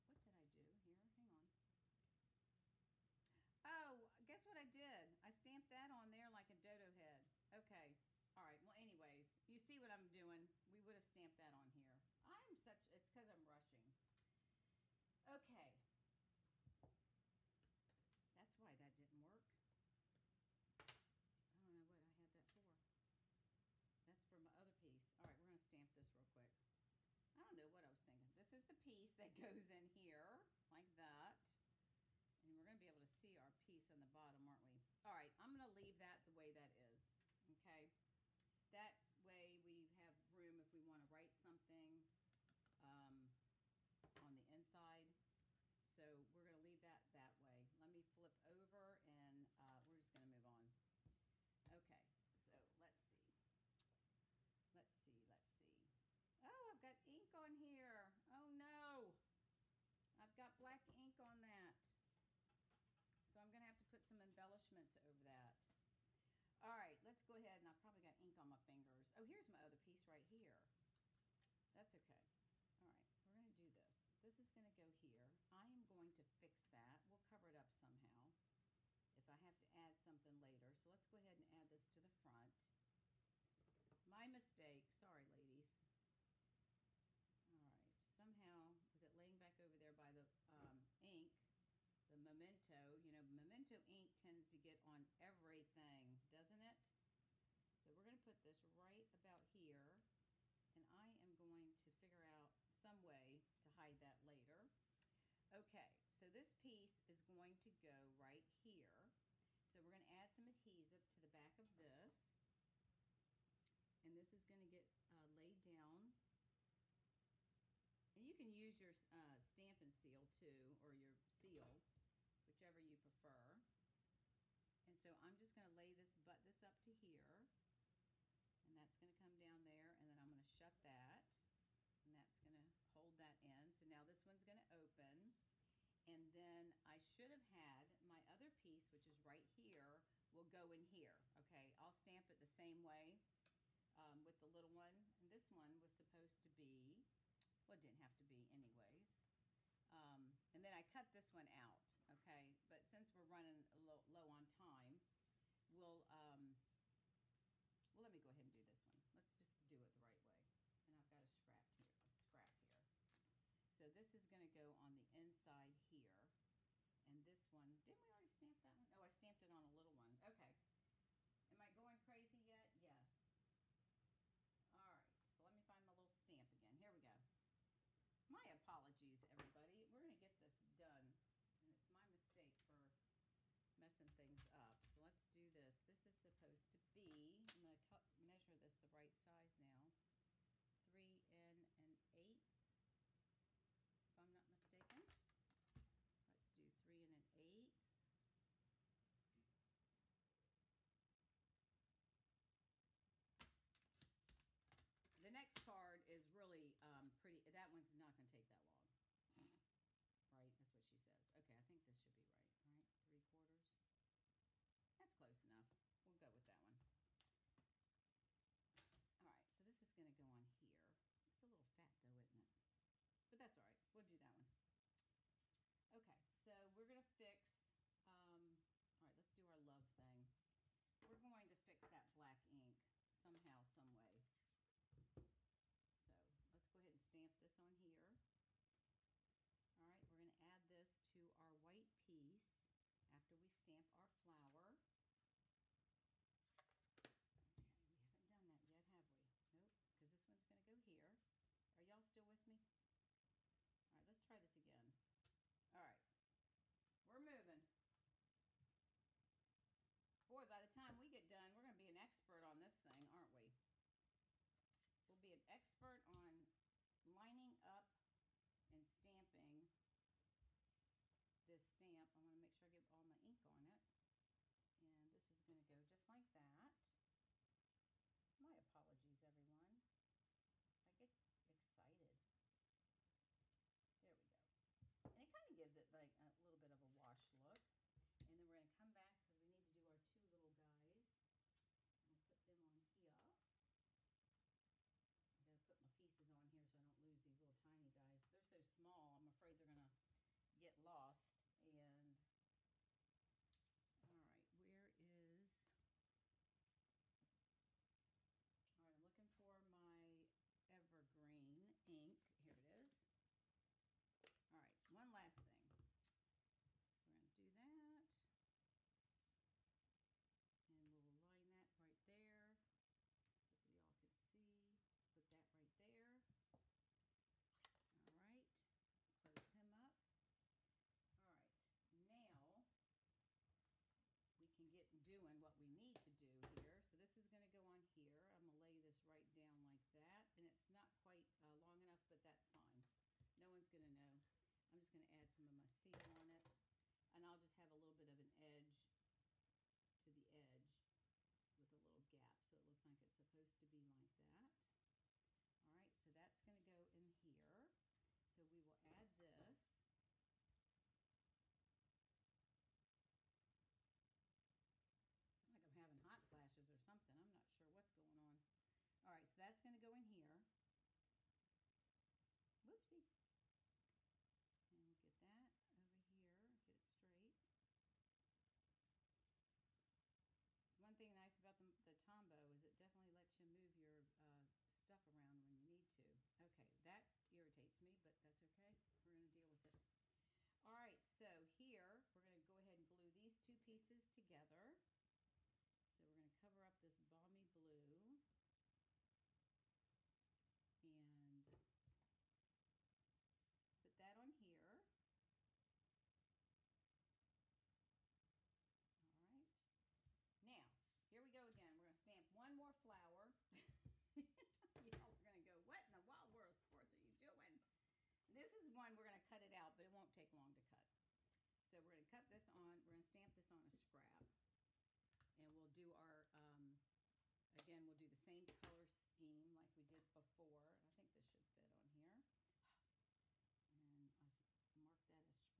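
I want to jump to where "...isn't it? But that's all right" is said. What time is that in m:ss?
3:42.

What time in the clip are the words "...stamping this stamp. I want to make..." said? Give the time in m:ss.
4:28.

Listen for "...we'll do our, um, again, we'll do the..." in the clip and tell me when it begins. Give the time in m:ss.
7:05.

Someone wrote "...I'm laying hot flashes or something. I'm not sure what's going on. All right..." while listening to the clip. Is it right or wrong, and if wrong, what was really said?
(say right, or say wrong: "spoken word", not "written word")
wrong: "having", not "laying".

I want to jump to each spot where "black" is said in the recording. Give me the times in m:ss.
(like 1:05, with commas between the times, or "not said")
1:00, 3:52.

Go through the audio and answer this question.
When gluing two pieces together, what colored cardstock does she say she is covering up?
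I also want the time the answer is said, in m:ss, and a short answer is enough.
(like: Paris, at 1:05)
balmy blue, at 6:36.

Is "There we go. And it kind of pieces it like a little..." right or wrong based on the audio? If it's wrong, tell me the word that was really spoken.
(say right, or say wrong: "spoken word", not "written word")
wrong: "gives", not "pieces".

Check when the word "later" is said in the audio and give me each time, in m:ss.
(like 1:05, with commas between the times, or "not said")
1:20, 1:44.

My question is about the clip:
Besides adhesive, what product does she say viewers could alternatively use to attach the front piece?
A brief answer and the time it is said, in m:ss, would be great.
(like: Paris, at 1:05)
Stampin' Seal, at 1:59.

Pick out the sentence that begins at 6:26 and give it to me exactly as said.
Okay, that irritates me, but that's okay.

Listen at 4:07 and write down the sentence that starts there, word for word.
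Okay, we haven't done that yet, have we?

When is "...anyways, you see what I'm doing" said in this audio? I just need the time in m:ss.
0:08.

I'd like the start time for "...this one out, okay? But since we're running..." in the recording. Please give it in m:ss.
2:31.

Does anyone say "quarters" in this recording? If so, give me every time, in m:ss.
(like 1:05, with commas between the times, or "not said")
3:33.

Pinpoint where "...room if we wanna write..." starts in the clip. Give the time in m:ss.
0:40.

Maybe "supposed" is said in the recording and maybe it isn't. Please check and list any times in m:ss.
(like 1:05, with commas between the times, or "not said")
2:25, 3:06, 5:53.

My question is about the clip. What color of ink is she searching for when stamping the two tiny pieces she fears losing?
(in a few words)
evergreen.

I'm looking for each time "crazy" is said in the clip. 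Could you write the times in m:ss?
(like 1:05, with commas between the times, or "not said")
2:52.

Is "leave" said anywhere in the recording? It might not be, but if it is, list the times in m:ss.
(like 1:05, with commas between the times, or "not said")
0:35, 0:46.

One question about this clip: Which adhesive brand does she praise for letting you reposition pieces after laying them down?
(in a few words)
Tombow.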